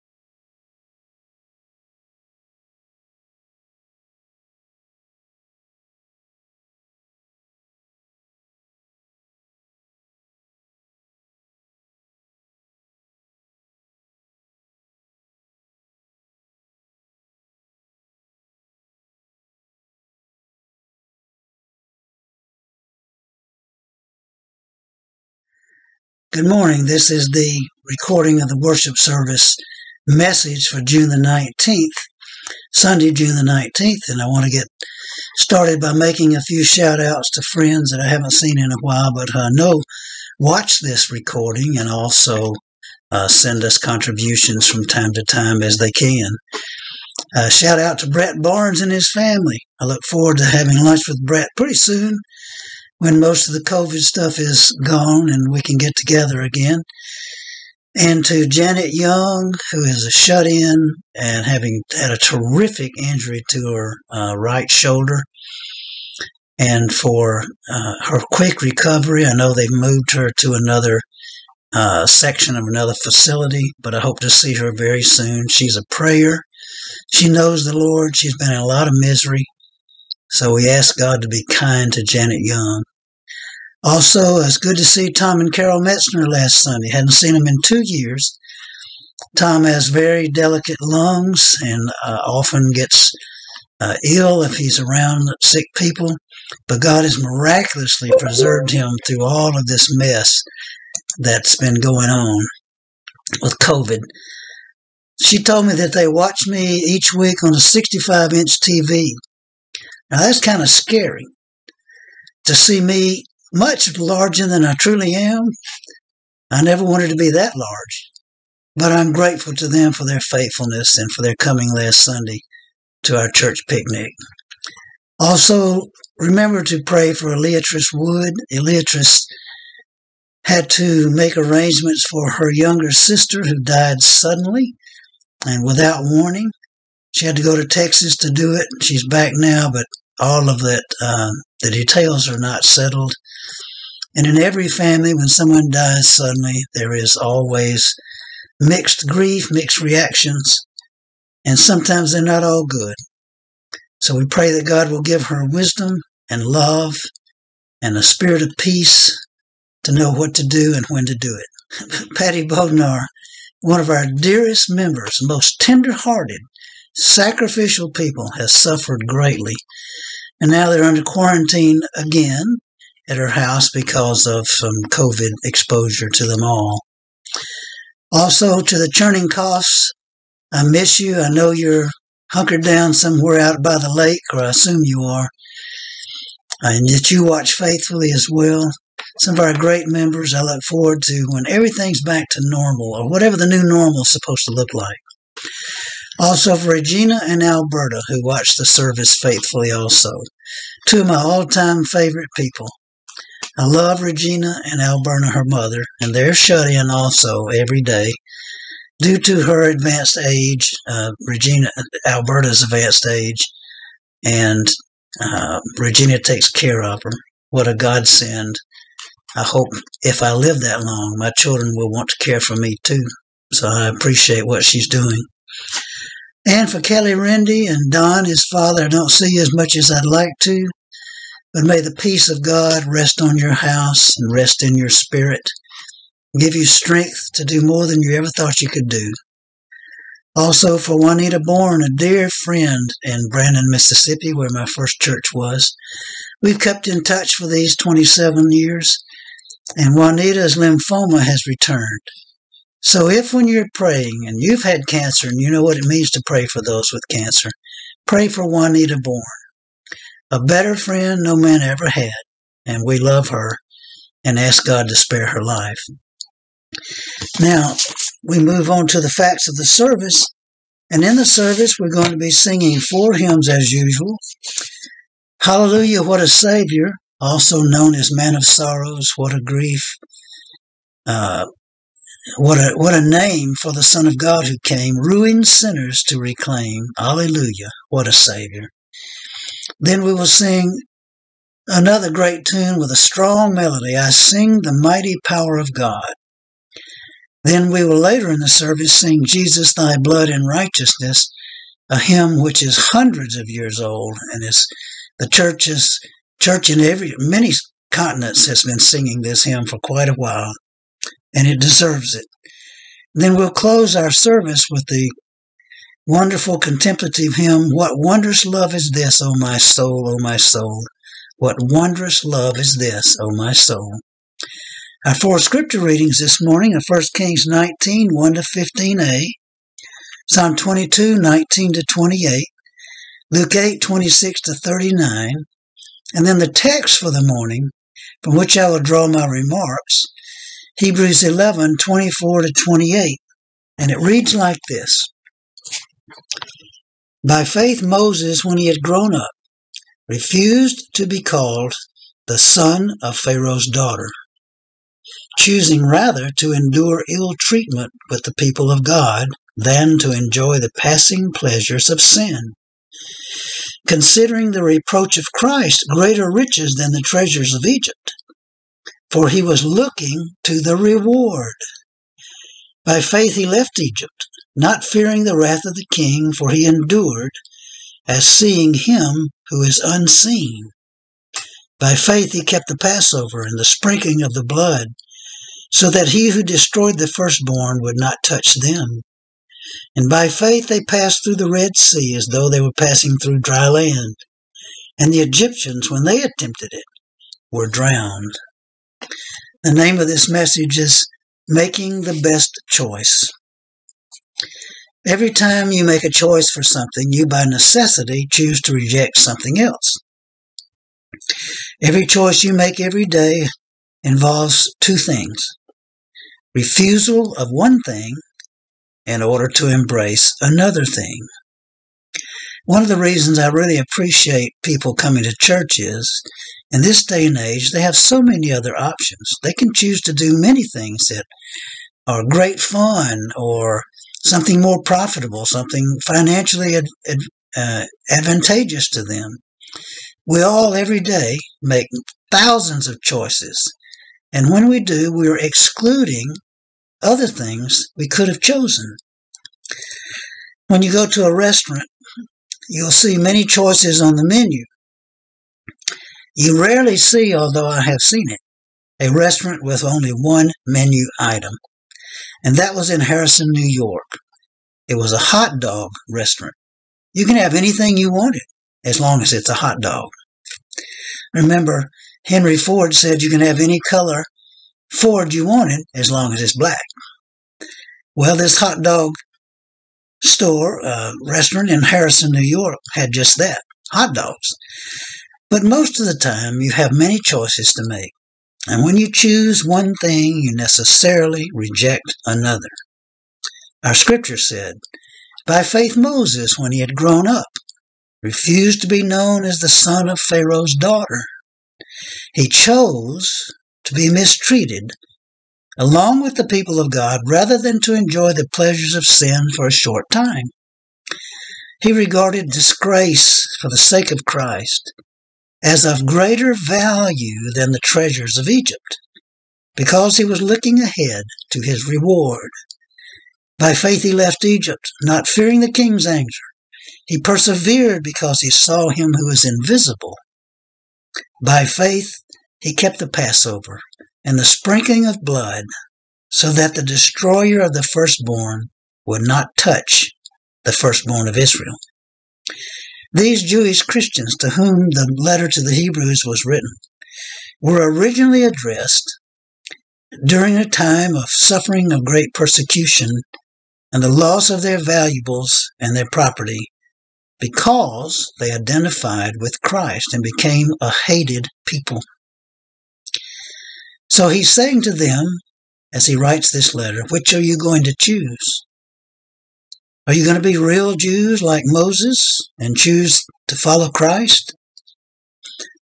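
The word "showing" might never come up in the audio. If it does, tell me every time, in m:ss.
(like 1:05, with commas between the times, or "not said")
not said.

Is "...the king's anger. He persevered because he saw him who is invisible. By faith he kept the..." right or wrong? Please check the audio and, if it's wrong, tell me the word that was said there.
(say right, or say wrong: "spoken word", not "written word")
right.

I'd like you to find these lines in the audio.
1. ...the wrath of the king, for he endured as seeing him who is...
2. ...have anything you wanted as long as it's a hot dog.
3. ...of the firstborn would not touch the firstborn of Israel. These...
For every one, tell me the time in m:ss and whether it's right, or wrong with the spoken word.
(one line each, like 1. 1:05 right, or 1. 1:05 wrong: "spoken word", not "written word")
1. 6:15 right
2. 7:47 right
3. 8:57 right.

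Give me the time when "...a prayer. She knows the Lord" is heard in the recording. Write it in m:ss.
1:15.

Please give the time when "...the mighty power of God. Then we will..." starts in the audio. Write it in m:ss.
4:54.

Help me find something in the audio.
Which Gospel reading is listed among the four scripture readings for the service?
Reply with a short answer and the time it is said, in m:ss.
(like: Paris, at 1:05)
Luke 8:26-39, at 5:33.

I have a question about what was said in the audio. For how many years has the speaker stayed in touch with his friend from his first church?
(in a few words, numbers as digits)
27.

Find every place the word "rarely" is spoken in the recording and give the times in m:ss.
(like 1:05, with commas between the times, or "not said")
7:36.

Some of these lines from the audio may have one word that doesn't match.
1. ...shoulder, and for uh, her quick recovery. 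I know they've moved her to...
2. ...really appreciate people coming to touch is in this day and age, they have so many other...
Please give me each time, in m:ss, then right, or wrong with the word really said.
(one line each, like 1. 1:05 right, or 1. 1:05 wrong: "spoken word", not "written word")
1. 1:04 right
2. 7:03 wrong: "church", not "touch".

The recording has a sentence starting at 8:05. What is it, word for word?
But most of the time, you have many choices to make.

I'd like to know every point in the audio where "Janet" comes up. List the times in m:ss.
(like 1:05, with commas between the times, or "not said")
0:58, 1:22.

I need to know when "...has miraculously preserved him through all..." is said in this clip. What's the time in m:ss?
1:37.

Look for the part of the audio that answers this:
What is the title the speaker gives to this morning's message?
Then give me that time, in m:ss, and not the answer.
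6:41.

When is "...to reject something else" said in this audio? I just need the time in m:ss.
6:48.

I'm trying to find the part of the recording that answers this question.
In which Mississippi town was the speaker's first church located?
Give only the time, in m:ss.
4:03.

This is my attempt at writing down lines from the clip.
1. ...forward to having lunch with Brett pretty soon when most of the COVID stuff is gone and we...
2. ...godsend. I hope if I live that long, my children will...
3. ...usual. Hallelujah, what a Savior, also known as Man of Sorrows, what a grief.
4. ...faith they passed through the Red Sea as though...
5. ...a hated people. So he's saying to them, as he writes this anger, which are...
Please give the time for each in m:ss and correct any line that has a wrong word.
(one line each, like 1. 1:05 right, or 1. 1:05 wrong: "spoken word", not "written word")
1. 0:50 right
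2. 3:37 right
3. 4:33 right
4. 6:30 right
5. 9:20 wrong: "letter", not "anger".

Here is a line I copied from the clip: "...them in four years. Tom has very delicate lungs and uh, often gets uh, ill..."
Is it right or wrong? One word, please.
wrong.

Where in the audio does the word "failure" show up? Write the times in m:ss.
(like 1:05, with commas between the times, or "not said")
not said.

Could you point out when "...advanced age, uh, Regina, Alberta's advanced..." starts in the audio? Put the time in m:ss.
3:29.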